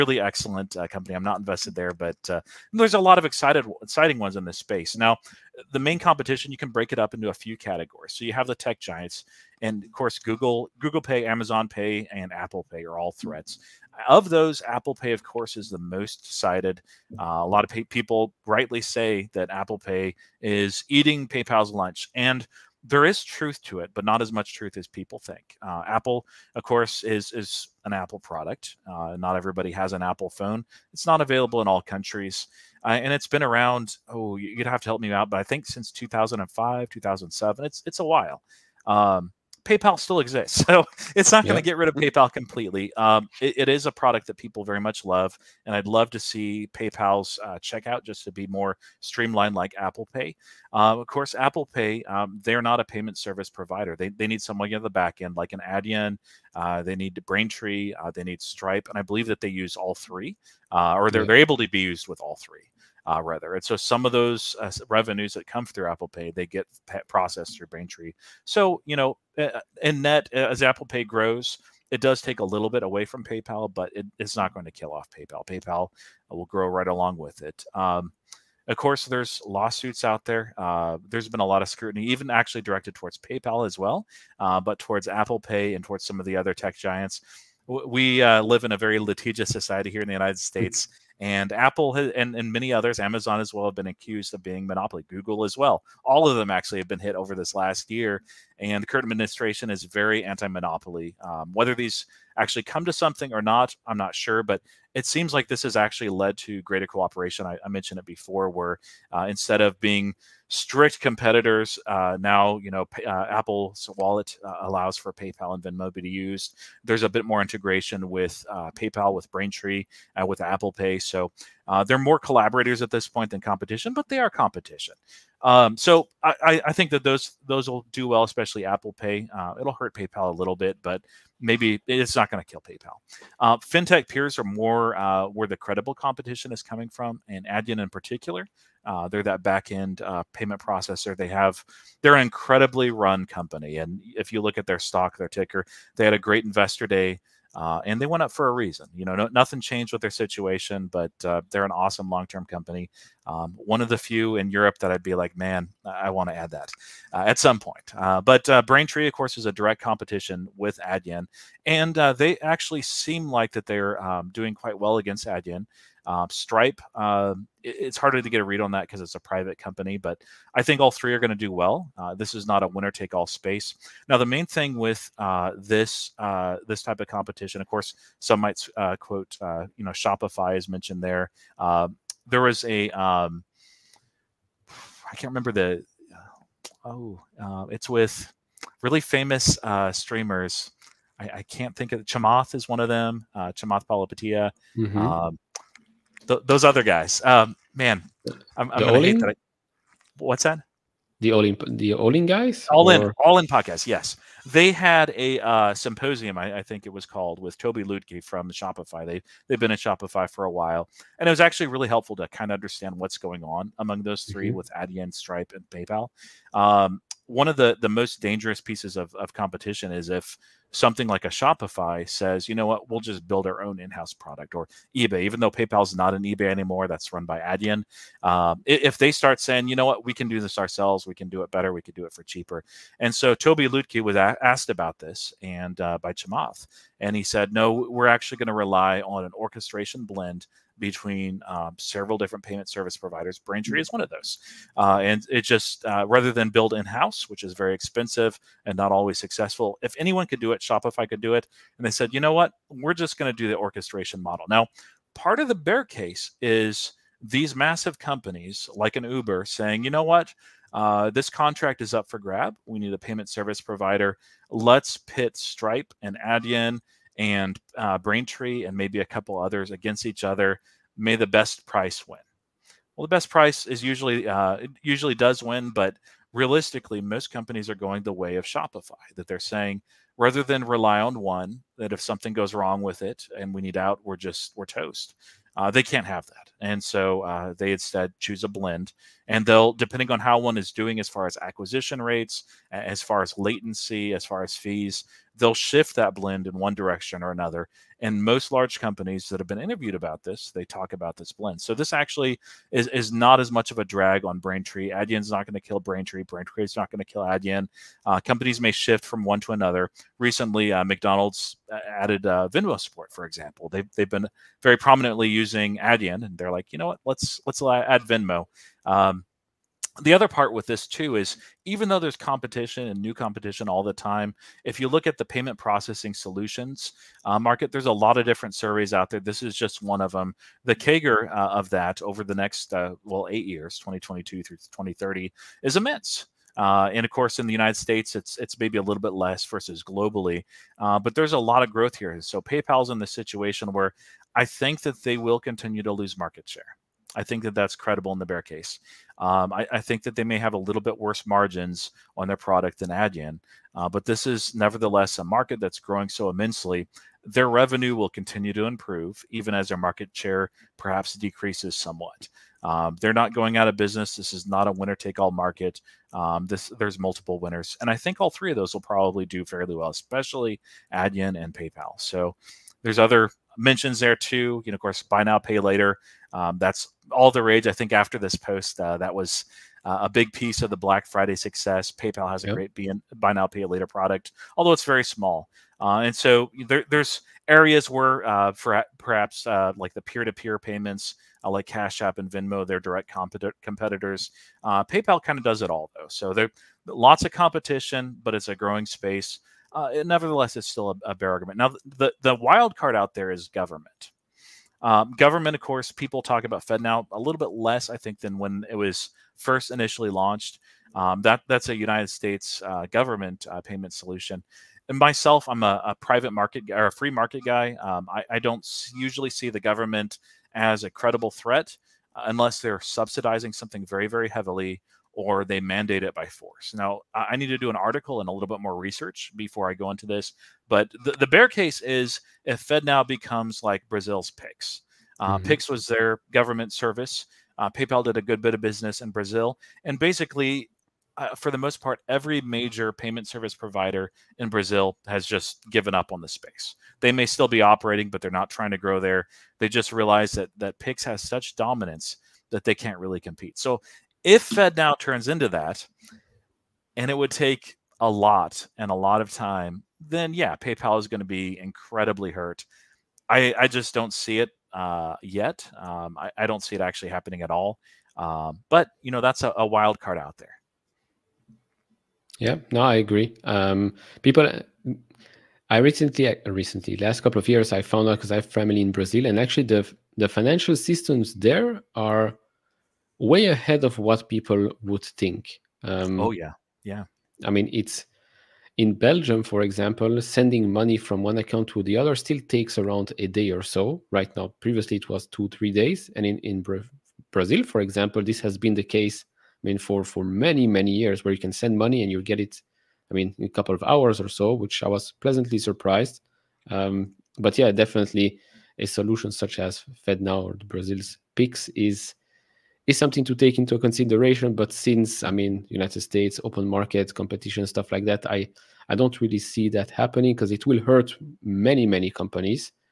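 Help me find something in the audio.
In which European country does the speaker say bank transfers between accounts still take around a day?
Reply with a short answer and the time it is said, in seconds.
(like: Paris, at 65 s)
Belgium, at 488 s.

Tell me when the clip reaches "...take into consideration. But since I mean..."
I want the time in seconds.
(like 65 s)
513 s.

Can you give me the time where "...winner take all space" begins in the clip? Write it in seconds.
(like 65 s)
172 s.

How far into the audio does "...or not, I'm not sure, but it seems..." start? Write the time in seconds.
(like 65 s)
103 s.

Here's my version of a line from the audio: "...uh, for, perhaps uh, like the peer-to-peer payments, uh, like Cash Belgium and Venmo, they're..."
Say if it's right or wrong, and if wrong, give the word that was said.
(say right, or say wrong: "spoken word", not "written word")
wrong: "App", not "Belgium".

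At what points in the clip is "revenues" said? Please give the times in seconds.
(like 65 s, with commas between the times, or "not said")
64 s, 357 s.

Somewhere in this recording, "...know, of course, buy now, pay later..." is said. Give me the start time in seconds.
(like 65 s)
374 s.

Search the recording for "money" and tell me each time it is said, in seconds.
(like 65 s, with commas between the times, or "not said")
490 s, 501 s.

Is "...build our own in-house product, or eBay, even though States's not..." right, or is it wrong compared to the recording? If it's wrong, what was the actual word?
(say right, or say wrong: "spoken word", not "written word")
wrong: "PayPal", not "States".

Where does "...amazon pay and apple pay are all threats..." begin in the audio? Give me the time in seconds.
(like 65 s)
11 s.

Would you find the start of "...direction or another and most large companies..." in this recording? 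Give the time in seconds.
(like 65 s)
296 s.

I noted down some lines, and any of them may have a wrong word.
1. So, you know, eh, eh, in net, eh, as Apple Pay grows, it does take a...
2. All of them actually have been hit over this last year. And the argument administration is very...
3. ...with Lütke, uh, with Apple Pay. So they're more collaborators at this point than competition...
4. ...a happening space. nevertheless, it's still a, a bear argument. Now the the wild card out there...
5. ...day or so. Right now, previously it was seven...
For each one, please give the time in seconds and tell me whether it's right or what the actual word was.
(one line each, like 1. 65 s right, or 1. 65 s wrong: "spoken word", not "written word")
1. 68 s right
2. 96 s wrong: "current", not "argument"
3. 119 s wrong: "Braintree", not "Lütke"
4. 398 s wrong: "growing", not "happening"
5. 493 s wrong: "two", not "seven".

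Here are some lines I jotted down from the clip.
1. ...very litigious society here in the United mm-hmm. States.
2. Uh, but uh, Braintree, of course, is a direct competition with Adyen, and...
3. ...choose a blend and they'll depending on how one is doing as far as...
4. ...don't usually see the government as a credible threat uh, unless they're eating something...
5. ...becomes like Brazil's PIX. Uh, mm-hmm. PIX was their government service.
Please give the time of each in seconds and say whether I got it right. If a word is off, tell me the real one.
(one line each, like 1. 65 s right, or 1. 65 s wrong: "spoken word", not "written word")
1. 88 s right
2. 157 s right
3. 288 s right
4. 418 s wrong: "subsidizing", not "eating"
5. 433 s right.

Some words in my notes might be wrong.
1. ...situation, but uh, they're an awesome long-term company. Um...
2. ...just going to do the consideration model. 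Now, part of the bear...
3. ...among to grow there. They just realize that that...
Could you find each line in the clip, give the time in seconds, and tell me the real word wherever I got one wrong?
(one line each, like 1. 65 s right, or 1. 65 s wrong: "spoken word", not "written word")
1. 150 s right
2. 252 s wrong: "orchestration", not "consideration"
3. 448 s wrong: "trying", not "among".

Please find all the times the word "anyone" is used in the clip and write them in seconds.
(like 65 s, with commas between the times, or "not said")
249 s.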